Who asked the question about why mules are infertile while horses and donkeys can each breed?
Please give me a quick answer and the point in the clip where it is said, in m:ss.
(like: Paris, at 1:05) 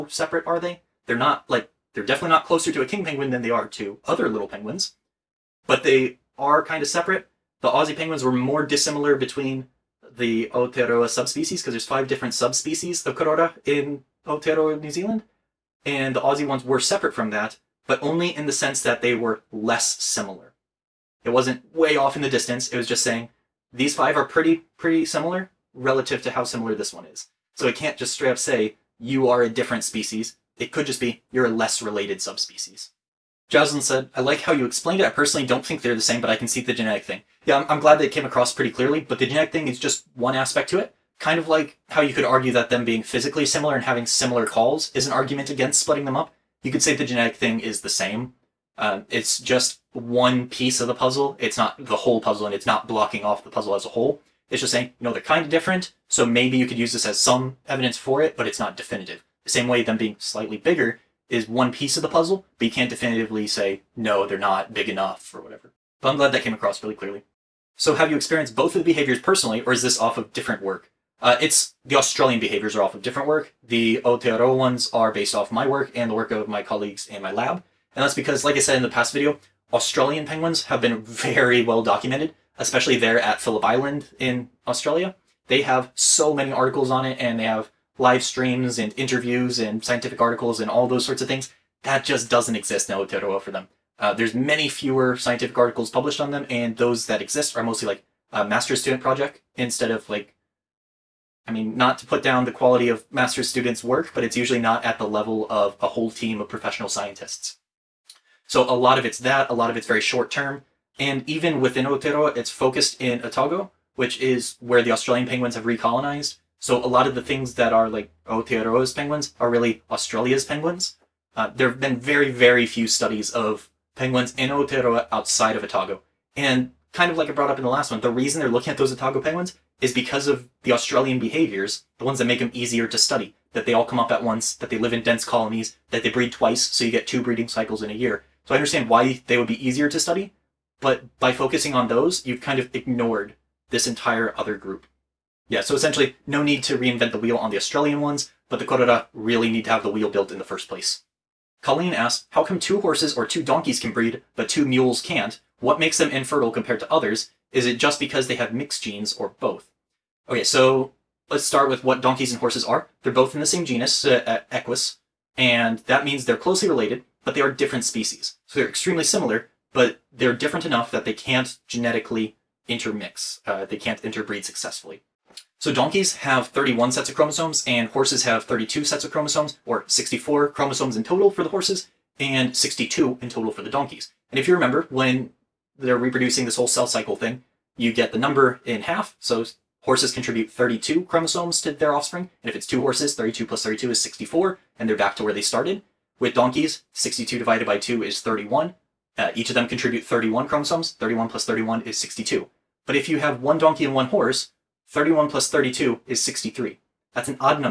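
Colleen, at 2:31.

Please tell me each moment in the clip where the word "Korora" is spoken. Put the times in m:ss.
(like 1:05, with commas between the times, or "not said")
0:13, 2:28.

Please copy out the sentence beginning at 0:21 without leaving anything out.
It wasn't way off in the distance.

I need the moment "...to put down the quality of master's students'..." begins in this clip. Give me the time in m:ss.
1:41.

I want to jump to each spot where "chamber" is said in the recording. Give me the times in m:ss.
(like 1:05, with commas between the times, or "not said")
not said.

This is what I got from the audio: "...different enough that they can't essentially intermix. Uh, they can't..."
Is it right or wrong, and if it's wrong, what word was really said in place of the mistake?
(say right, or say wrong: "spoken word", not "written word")
wrong: "genetically", not "essentially".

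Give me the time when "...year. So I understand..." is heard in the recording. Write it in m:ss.
2:17.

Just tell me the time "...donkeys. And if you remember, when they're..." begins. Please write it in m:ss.
3:03.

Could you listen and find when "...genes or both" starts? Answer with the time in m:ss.
2:38.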